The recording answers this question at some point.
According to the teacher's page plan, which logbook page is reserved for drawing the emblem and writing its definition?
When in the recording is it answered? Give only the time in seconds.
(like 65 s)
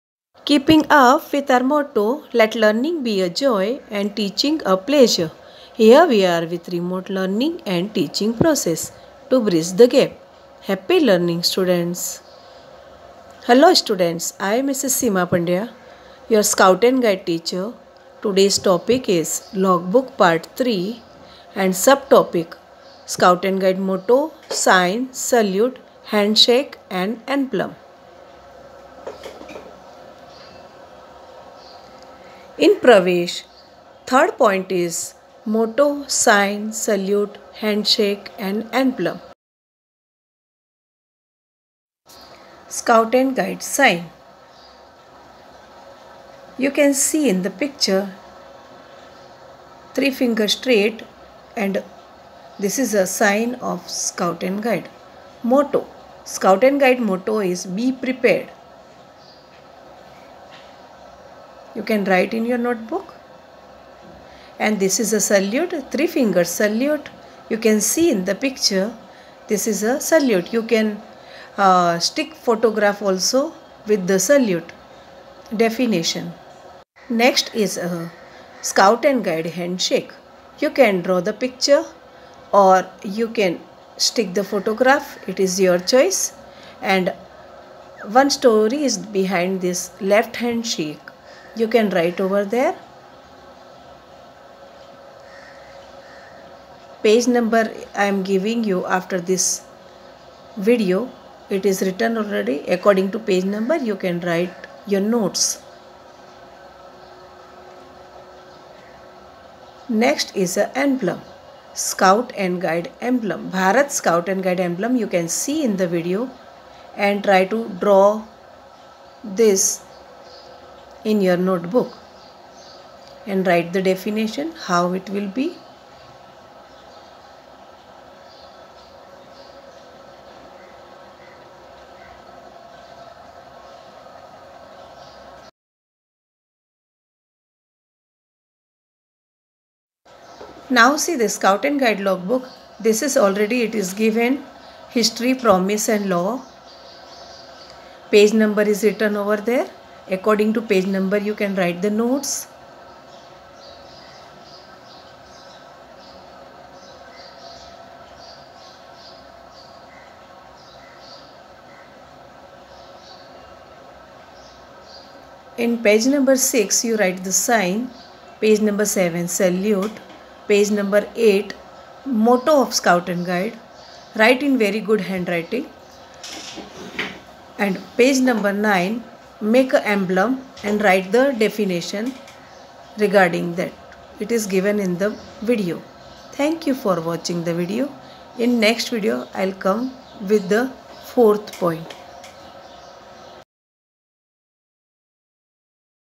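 178 s.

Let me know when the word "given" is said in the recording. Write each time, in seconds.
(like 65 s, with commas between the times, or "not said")
143 s, 184 s.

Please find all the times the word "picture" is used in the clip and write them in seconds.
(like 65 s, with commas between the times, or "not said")
47 s, 68 s, 81 s.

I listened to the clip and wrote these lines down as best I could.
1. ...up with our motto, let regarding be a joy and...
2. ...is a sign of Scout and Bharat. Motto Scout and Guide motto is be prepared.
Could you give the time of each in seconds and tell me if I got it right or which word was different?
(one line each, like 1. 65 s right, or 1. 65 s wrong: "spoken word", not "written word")
1. 0 s wrong: "learning", not "regarding"
2. 52 s wrong: "Guide", not "Bharat".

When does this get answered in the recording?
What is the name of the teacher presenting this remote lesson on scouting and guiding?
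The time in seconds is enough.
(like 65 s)
14 s.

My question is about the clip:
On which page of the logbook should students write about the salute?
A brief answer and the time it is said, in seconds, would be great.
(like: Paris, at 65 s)
7, at 168 s.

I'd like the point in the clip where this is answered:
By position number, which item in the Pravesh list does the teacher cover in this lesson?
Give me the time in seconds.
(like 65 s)
34 s.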